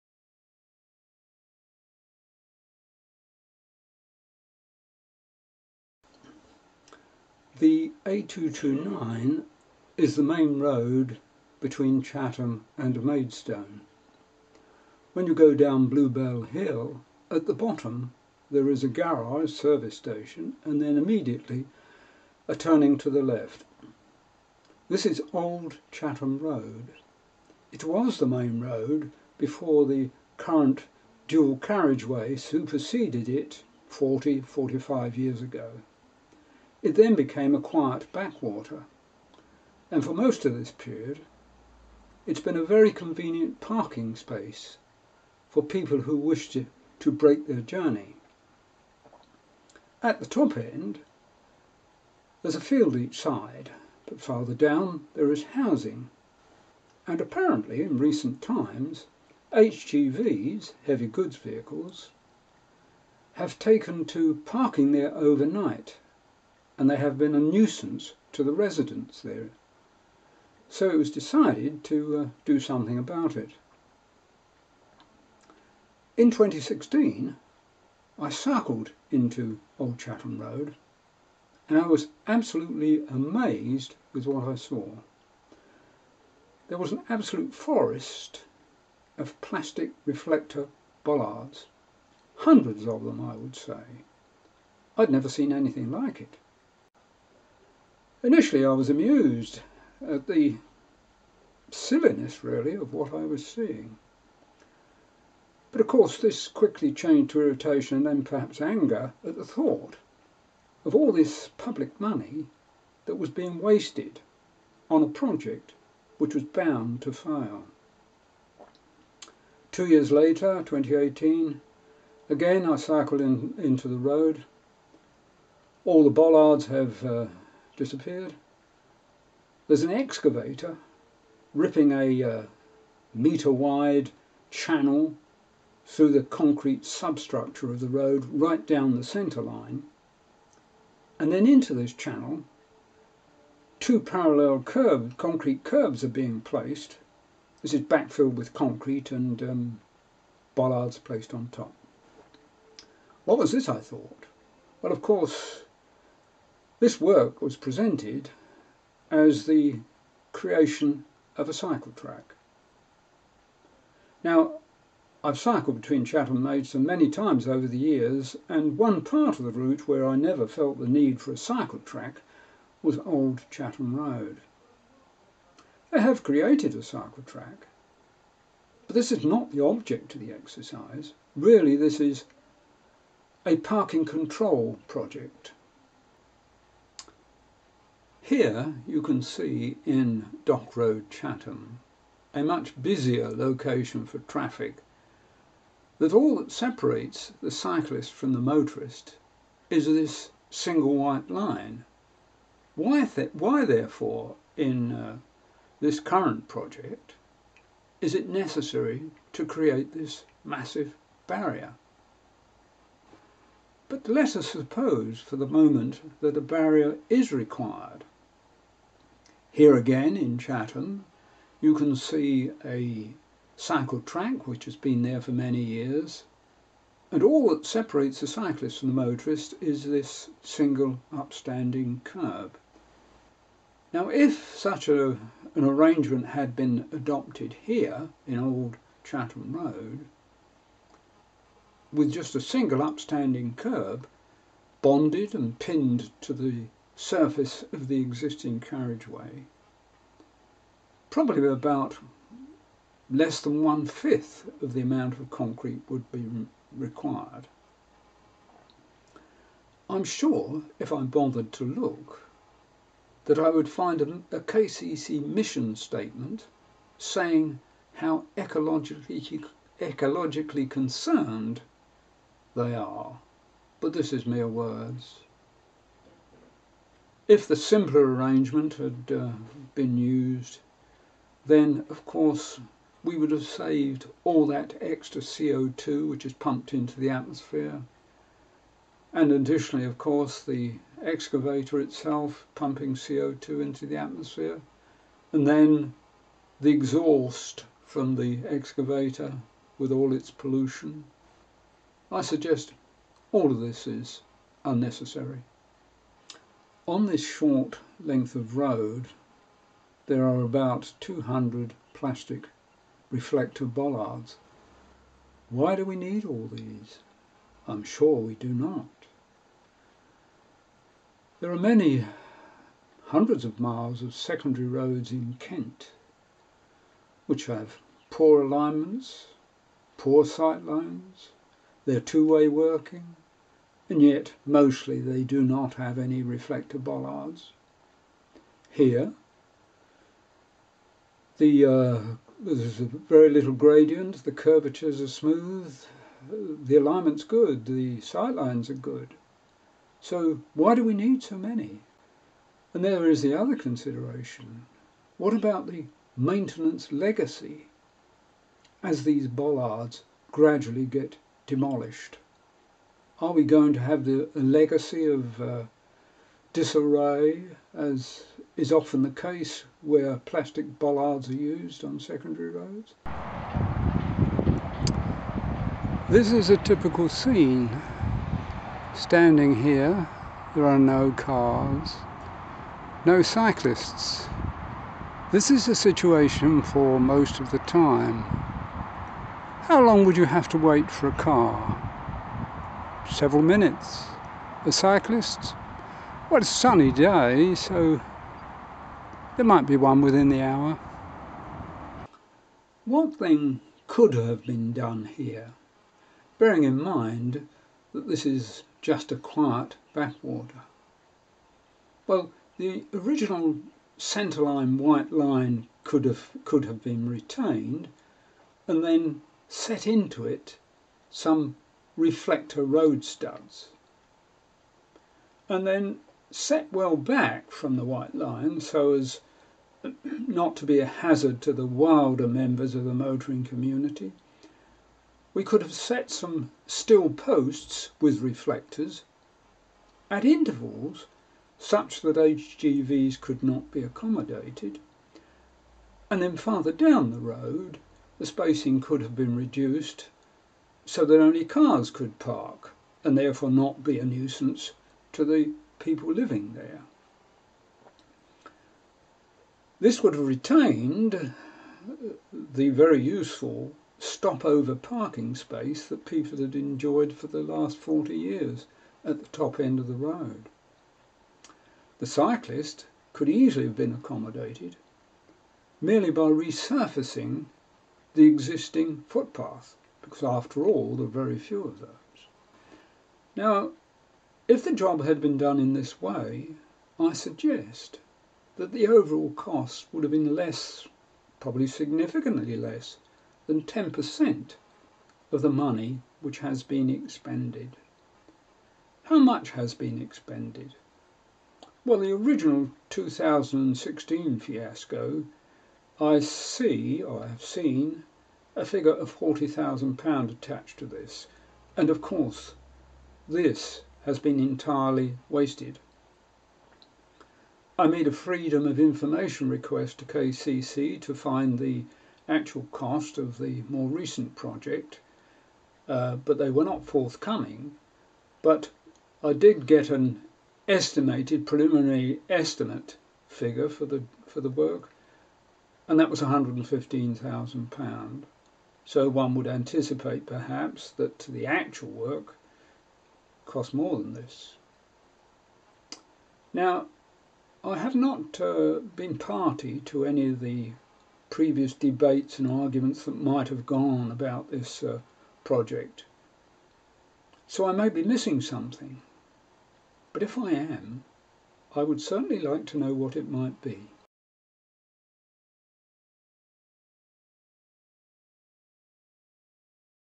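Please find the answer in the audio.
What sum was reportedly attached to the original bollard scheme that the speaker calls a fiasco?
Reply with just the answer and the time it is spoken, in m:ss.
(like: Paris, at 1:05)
£40,000, at 8:29.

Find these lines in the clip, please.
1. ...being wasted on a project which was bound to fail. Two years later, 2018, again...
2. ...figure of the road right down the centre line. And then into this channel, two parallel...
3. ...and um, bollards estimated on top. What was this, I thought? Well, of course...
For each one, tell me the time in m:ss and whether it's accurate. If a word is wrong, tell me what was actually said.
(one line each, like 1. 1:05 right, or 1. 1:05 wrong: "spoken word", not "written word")
1. 1:53 right
2. 2:16 wrong: "substructure", not "figure"
3. 2:29 wrong: "placed", not "estimated".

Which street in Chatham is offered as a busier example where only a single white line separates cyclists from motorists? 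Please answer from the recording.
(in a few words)
Dock Road.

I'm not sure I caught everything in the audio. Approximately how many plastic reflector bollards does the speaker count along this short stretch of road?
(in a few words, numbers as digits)
200.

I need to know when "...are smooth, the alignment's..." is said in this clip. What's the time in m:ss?
5:45.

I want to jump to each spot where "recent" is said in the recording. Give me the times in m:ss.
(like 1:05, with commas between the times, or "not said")
0:57, 8:43.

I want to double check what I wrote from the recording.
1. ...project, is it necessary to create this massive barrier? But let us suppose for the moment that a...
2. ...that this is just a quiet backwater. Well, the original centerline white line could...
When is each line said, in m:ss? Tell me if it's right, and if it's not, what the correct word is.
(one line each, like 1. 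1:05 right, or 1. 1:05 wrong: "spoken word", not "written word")
1. 3:26 right
2. 6:47 right.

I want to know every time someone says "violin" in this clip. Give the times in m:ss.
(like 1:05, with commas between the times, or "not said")
not said.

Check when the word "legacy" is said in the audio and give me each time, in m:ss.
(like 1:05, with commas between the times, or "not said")
5:56, 6:04.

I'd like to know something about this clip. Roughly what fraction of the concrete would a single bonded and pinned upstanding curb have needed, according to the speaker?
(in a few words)
less than one-fifth.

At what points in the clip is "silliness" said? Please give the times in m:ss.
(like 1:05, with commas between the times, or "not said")
1:41.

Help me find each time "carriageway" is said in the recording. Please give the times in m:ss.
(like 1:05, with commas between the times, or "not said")
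0:31, 4:08.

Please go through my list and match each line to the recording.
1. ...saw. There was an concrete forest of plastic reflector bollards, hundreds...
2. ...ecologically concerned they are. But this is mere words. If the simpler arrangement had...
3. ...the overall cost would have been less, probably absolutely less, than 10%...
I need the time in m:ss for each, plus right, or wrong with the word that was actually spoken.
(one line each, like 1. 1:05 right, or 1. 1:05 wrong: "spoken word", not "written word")
1. 1:24 wrong: "absolute", not "concrete"
2. 4:29 right
3. 8:08 wrong: "significantly", not "absolutely".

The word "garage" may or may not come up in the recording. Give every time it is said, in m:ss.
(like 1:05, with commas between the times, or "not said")
0:18.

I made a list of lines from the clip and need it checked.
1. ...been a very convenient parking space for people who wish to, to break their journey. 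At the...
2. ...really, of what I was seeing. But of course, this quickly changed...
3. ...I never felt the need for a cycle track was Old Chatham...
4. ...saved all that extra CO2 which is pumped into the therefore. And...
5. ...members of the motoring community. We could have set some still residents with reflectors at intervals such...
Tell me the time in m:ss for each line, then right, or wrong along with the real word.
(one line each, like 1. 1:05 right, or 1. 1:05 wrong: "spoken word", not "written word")
1. 0:42 right
2. 1:42 right
3. 2:50 right
4. 4:43 wrong: "atmosphere", not "therefore"
5. 7:12 wrong: "posts", not "residents".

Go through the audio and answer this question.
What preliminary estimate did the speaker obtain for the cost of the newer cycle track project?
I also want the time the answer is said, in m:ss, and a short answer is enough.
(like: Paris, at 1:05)
£115,000, at 8:56.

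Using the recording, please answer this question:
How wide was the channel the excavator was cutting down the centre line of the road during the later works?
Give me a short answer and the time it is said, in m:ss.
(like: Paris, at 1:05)
1 metre, at 2:13.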